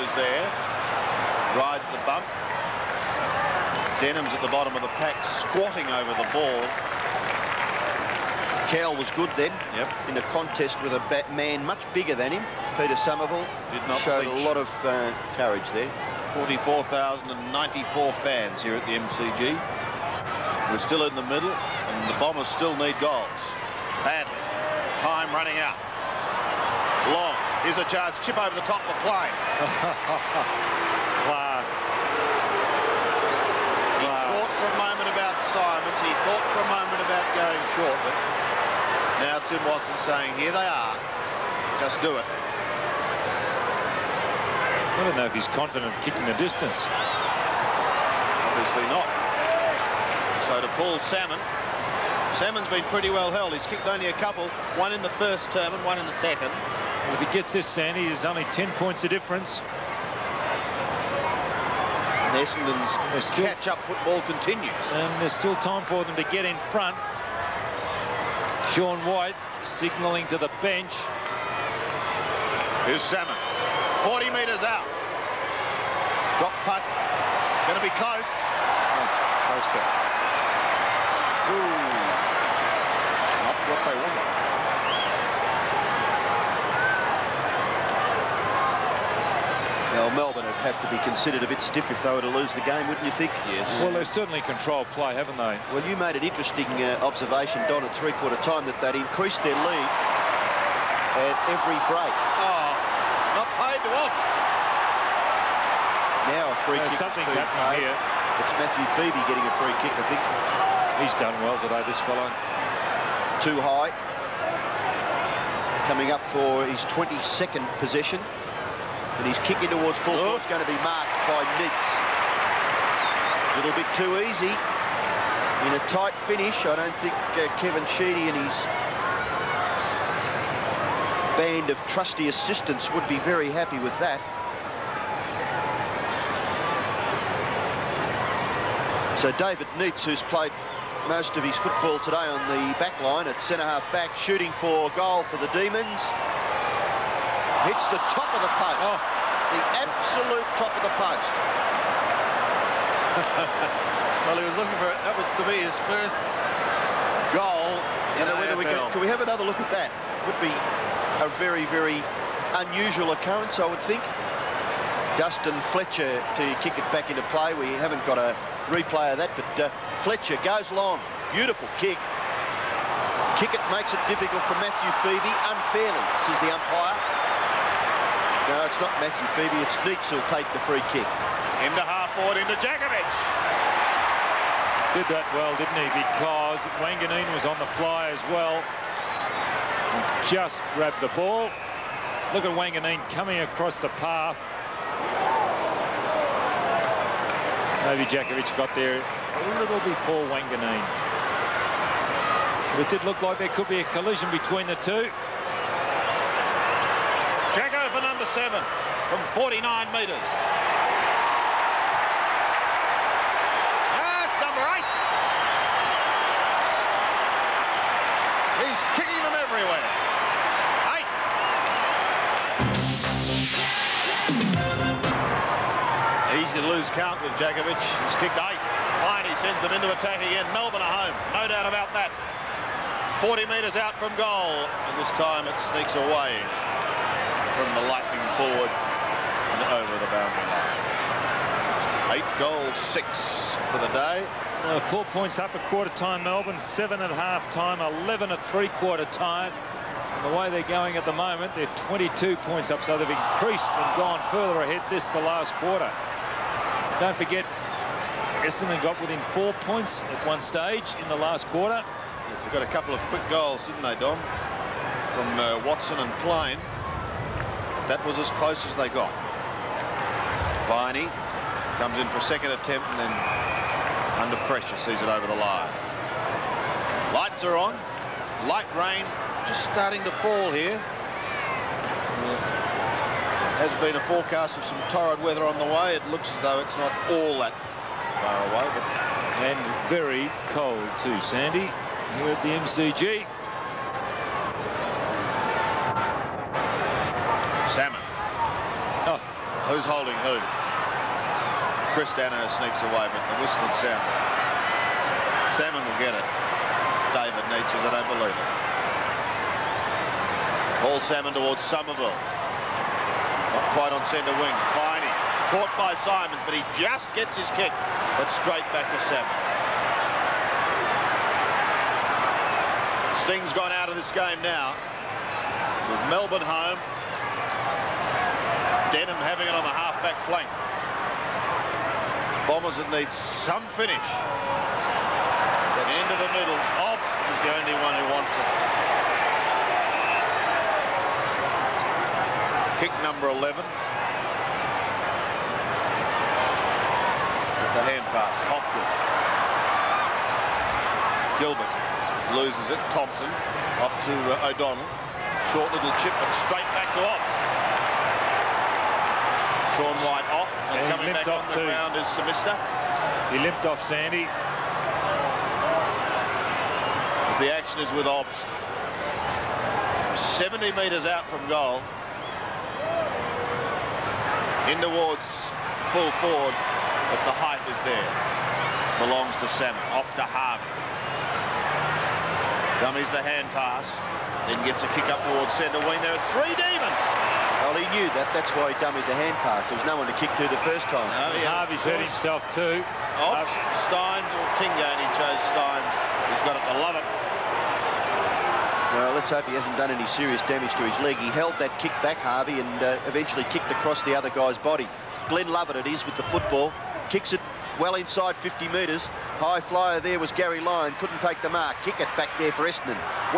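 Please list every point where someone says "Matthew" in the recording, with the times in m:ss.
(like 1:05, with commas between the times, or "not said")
1:48, 2:54, 2:58.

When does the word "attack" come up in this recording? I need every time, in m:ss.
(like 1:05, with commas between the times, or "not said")
3:49.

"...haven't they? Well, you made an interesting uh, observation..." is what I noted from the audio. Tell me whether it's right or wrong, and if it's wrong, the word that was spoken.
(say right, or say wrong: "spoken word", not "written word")
right.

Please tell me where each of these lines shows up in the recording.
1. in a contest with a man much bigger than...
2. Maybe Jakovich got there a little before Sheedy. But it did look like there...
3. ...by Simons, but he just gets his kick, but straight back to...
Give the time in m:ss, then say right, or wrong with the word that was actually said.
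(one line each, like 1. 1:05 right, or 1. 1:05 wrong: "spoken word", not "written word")
1. 0:10 right
2. 3:17 wrong: "Wanganeen", not "Sheedy"
3. 5:15 right.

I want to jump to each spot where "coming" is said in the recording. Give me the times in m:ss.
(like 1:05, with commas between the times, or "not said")
1:55, 3:13, 6:00.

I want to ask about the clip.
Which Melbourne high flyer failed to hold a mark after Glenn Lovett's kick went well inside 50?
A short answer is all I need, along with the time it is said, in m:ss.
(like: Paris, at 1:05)
Garry Lyon, at 6:50.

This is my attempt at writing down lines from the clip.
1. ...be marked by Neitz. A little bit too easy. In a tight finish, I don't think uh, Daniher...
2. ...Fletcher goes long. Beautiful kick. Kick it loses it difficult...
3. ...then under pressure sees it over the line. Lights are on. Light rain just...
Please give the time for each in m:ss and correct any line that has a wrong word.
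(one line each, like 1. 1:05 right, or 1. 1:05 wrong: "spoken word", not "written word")
1. 2:00 wrong: "Kevin", not "Daniher"
2. 2:49 wrong: "makes", not "loses"
3. 4:32 right.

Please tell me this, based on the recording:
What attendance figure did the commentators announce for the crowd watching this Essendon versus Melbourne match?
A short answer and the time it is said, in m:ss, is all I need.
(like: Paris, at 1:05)
44,094, at 0:16.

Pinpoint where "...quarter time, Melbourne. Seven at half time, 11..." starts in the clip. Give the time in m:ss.
4:05.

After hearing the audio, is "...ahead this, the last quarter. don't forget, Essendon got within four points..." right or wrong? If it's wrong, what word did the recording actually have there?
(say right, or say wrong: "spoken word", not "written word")
right.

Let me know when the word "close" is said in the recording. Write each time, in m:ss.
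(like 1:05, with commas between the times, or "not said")
1:17, 4:28.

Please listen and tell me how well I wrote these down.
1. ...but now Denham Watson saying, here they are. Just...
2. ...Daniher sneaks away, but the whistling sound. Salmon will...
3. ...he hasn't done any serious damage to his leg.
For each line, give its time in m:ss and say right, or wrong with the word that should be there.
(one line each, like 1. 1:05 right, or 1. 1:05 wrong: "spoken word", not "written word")
1. 0:38 wrong: "Tim", not "Denham"
2. 5:02 right
3. 6:39 right.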